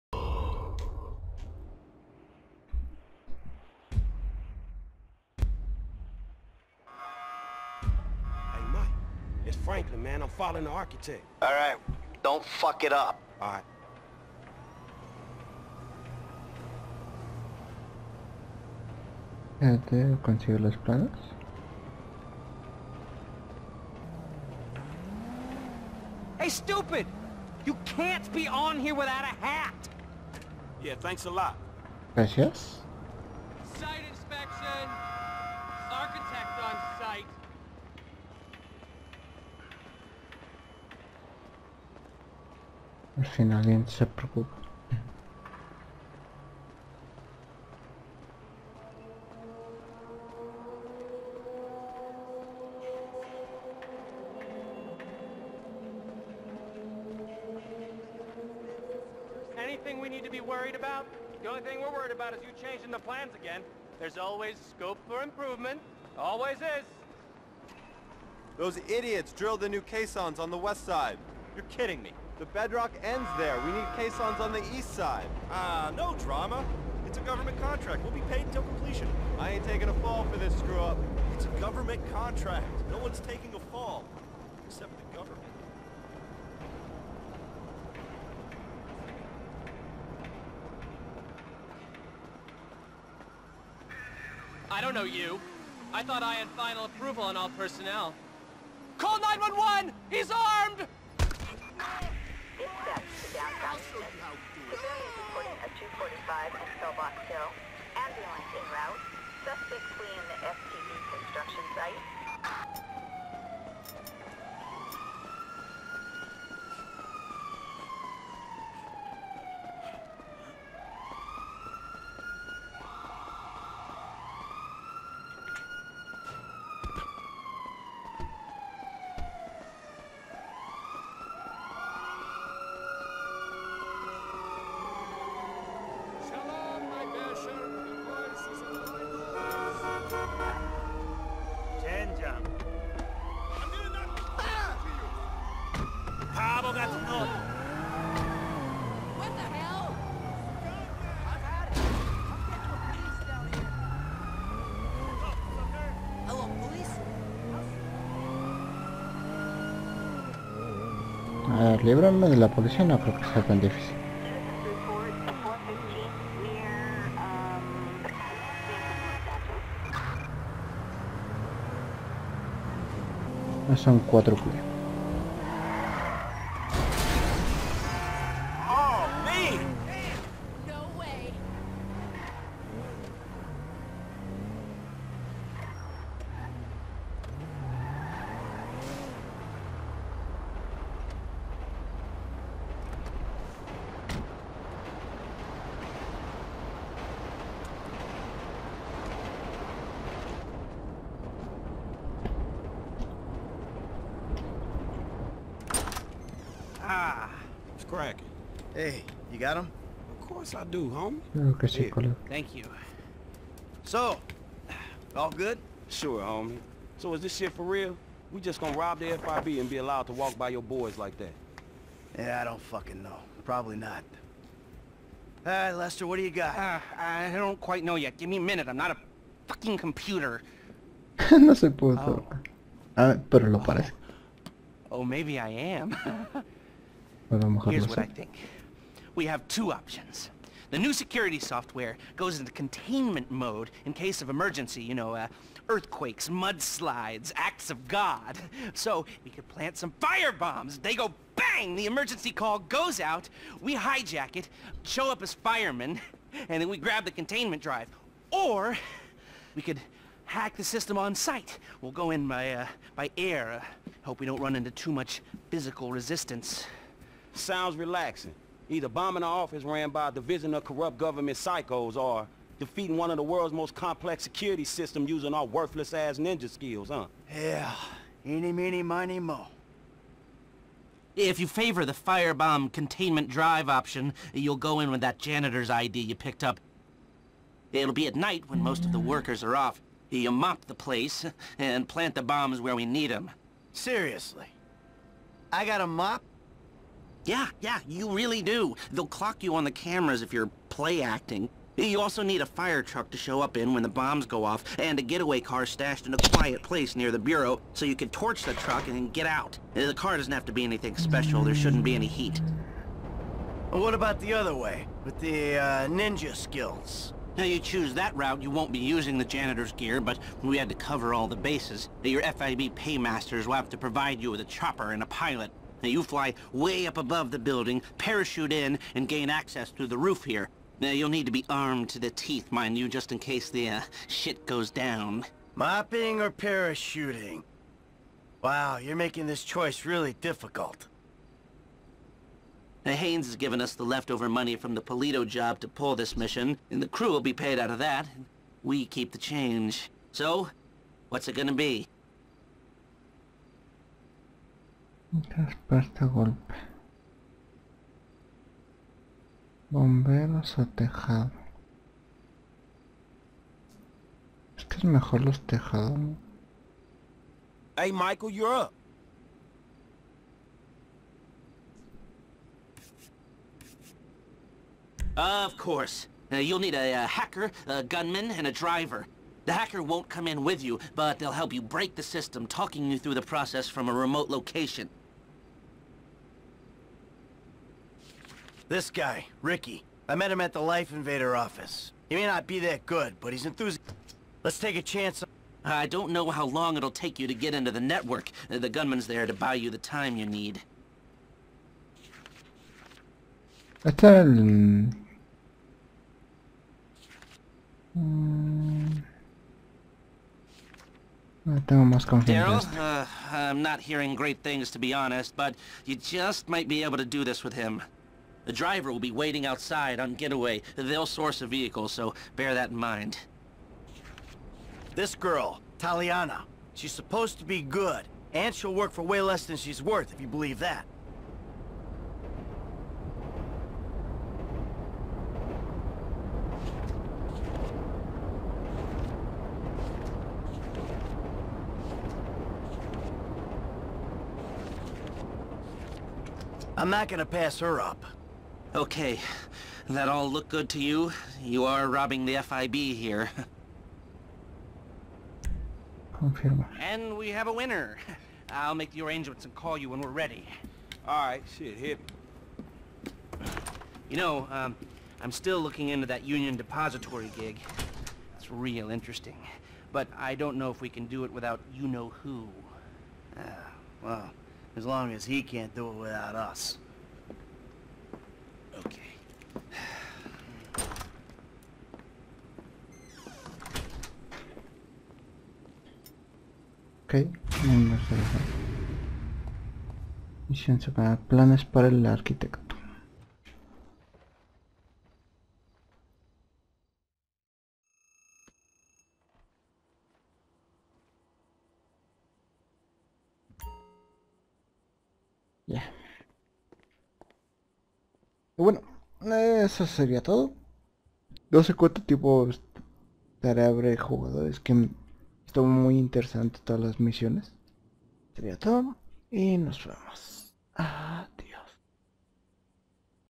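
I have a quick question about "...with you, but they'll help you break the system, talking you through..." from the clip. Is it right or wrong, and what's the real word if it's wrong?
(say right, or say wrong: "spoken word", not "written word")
right.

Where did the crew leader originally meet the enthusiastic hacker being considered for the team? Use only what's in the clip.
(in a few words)
LifeInvader office.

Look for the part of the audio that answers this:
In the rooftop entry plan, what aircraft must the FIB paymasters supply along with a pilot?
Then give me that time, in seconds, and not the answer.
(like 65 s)
324 s.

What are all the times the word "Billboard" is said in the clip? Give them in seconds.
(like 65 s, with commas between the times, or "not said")
not said.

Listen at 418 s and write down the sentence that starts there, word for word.
The driver will be waiting outside on getaway.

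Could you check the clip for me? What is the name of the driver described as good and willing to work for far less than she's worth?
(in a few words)
Taliana.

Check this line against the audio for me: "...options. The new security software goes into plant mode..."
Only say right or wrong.
wrong.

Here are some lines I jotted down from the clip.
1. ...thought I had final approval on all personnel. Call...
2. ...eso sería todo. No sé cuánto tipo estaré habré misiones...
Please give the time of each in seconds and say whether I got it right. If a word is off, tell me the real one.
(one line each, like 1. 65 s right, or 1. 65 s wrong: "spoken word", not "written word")
1. 96 s right
2. 509 s wrong: "jugadores", not "misiones".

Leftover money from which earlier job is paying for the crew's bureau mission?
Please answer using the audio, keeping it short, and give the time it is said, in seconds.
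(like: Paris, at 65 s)
Paleto job, at 344 s.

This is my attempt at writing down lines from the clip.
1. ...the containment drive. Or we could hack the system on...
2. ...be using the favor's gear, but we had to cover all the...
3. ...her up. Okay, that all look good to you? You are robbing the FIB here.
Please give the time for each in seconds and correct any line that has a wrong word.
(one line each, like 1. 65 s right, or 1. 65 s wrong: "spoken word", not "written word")
1. 257 s right
2. 318 s wrong: "janitor", not "favor"
3. 447 s right.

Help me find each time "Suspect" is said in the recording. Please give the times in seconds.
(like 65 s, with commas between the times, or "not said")
104 s, 109 s.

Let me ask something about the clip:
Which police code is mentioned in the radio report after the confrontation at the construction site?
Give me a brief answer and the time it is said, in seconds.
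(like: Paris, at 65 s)
245, at 105 s.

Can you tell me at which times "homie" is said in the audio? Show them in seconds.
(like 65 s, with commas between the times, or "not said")
210 s, 216 s.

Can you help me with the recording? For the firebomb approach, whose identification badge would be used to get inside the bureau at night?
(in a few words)
Janitor's ID.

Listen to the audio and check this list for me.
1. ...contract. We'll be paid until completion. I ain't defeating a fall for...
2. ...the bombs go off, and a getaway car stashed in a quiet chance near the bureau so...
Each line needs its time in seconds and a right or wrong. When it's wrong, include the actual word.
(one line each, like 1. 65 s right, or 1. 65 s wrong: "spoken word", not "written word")
1. 77 s wrong: "taking", not "defeating"
2. 303 s wrong: "place", not "chance".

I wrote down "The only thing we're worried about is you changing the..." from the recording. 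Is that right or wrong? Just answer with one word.
right.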